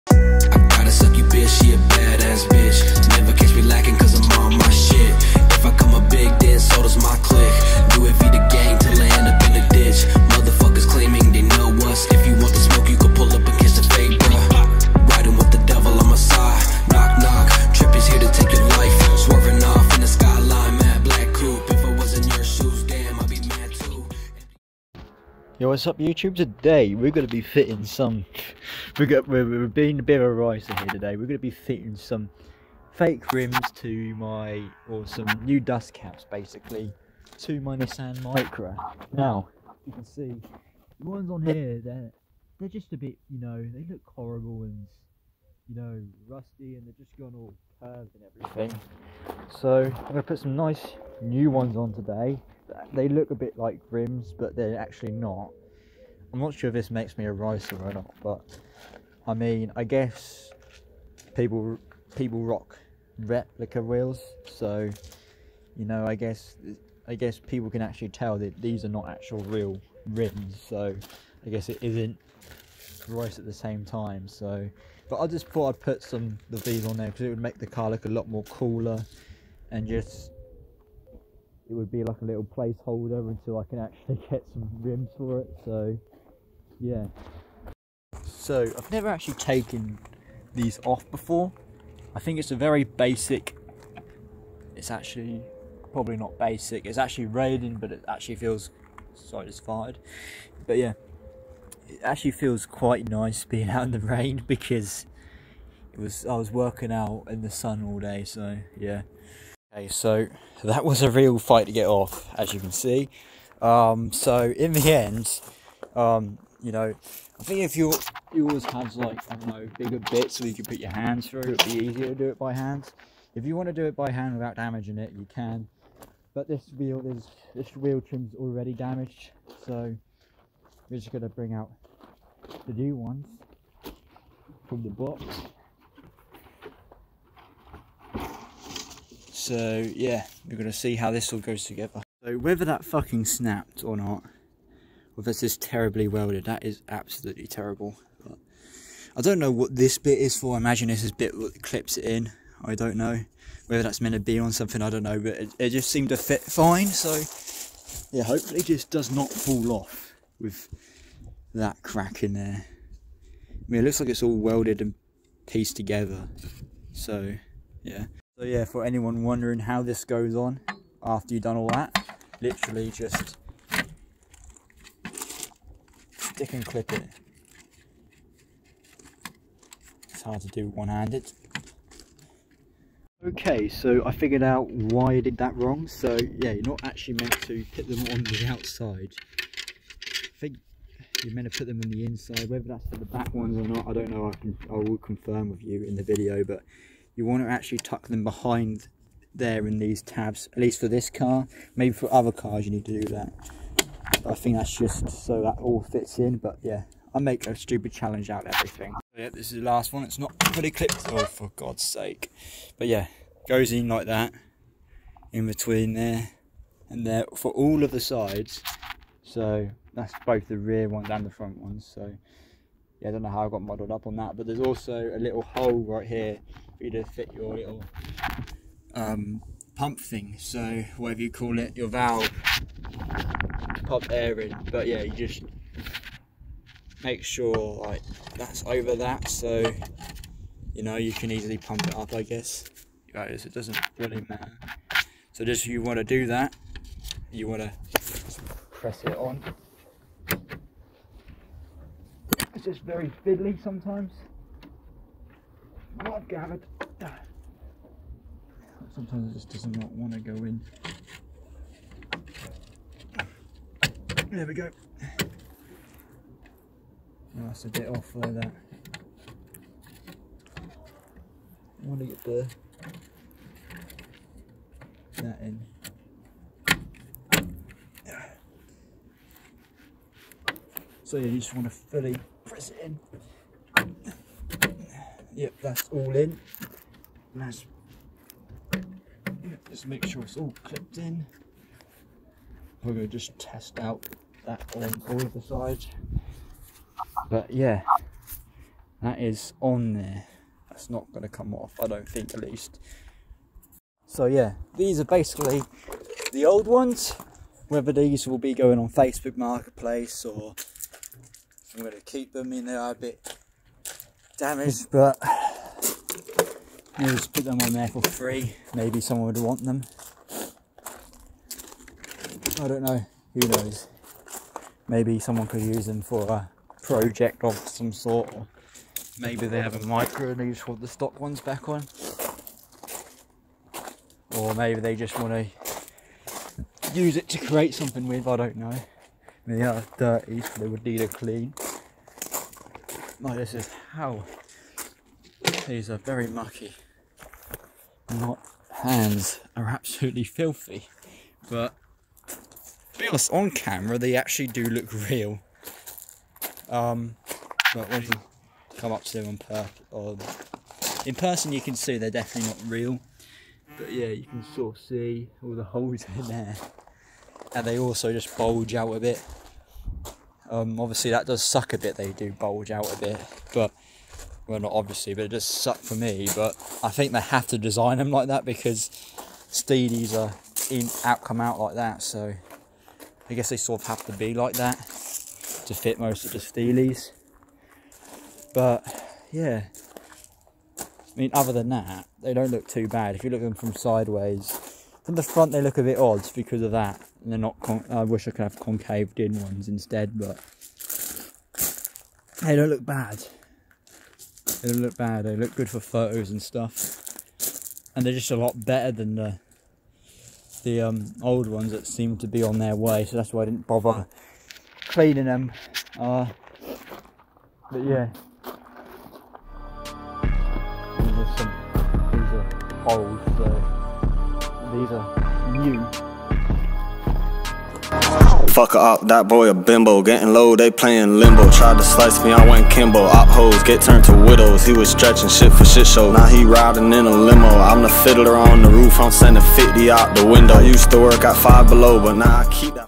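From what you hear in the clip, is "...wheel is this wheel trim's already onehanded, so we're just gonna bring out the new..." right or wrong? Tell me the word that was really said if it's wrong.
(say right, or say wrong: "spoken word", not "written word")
wrong: "damaged", not "onehanded".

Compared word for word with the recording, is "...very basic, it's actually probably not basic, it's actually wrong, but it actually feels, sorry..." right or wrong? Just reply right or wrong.
wrong.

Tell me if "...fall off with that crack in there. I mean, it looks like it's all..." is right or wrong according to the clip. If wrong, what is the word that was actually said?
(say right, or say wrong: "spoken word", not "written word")
right.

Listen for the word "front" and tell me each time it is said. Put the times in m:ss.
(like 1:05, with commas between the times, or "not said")
3:41, 6:35.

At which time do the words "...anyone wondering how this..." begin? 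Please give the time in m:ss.
2:48.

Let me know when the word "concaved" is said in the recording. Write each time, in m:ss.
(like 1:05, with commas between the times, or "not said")
6:38.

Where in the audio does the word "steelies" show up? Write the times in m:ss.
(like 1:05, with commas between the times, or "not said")
6:19, 6:26.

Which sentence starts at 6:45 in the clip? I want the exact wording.
They look good for photos and stuff.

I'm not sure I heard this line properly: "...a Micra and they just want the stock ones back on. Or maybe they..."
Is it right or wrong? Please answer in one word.
right.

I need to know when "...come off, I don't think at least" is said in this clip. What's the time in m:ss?
5:01.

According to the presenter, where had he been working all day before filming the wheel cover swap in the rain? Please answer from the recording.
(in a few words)
in the sun.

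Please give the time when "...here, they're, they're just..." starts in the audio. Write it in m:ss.
0:41.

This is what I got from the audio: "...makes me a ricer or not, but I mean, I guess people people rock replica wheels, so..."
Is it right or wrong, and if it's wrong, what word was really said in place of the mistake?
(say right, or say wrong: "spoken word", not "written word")
right.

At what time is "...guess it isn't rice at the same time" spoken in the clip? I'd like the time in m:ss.
1:11.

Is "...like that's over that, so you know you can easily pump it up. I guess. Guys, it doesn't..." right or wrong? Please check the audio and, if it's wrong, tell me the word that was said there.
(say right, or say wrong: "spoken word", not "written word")
right.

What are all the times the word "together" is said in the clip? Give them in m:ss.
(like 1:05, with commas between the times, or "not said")
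2:21, 2:45.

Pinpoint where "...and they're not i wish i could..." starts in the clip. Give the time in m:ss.
6:37.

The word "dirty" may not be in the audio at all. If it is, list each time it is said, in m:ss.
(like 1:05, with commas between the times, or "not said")
5:39.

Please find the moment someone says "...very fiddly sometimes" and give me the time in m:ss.
4:12.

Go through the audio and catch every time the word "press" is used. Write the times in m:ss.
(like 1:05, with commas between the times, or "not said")
4:08, 4:42.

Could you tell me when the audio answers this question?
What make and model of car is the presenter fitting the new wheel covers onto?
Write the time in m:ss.
0:37.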